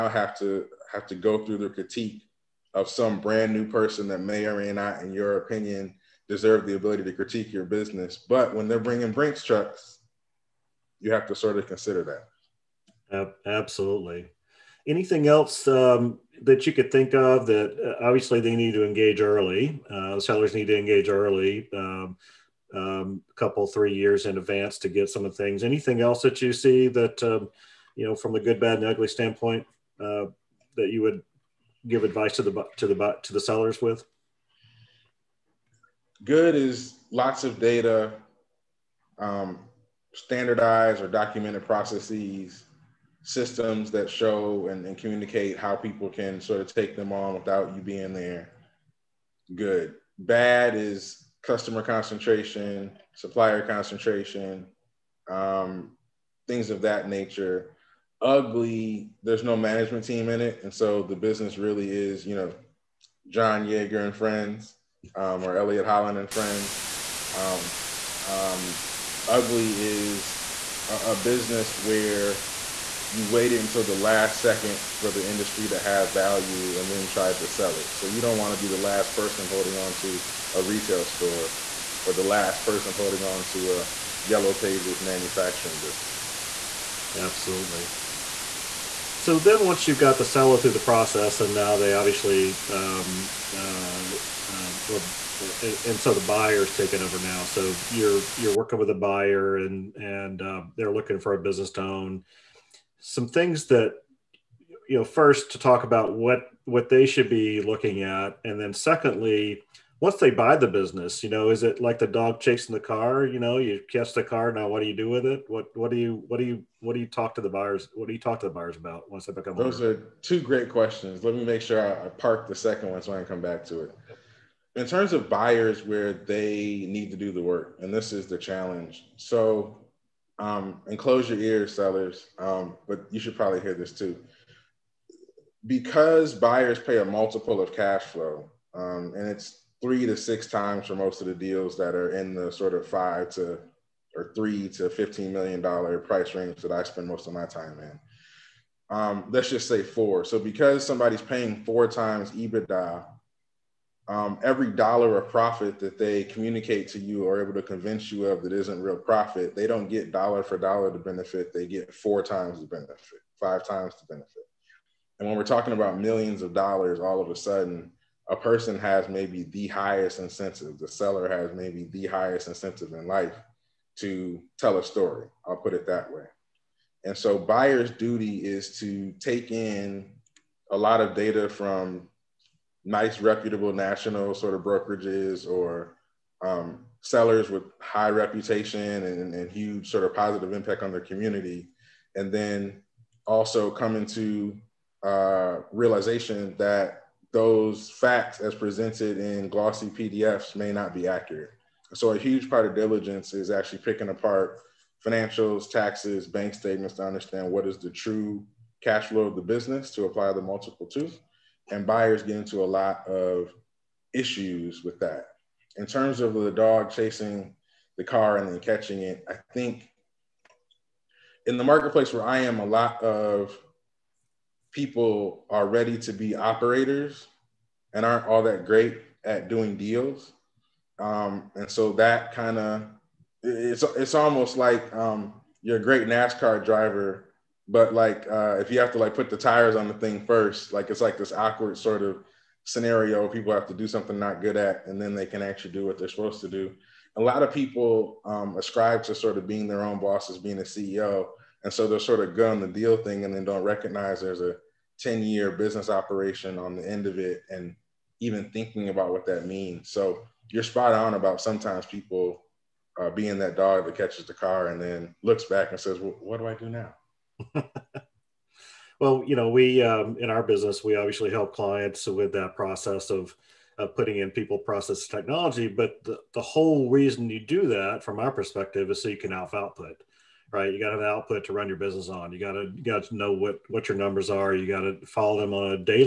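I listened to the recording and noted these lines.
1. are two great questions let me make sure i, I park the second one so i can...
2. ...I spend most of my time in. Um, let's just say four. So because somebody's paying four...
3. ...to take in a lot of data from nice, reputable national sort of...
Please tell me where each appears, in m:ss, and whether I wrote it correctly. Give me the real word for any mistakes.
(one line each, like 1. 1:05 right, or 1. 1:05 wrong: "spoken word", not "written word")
1. 1:59 right
2. 2:26 right
3. 2:58 right.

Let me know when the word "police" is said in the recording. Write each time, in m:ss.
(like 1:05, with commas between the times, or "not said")
not said.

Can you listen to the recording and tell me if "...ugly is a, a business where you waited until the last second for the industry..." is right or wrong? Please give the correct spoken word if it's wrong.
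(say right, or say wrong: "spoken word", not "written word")
right.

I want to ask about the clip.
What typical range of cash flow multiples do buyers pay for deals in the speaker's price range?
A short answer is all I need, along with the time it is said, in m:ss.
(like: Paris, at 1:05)
3 to 6 times, at 2:19.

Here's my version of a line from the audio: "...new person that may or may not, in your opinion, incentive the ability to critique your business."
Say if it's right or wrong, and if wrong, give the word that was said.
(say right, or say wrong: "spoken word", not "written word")
wrong: "deserve", not "incentive".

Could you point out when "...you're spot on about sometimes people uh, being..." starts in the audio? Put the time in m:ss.
4:20.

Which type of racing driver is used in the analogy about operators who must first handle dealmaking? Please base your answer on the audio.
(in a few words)
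NASCAR.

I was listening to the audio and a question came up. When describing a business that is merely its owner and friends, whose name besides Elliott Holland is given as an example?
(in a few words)
John Yeager.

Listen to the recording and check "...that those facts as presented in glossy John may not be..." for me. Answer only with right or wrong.
wrong.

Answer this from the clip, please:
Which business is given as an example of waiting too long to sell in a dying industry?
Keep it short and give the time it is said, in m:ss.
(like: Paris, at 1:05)
Yellow Pages, at 1:24.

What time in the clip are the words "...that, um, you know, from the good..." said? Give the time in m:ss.
0:26.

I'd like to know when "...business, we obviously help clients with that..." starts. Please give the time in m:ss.
4:30.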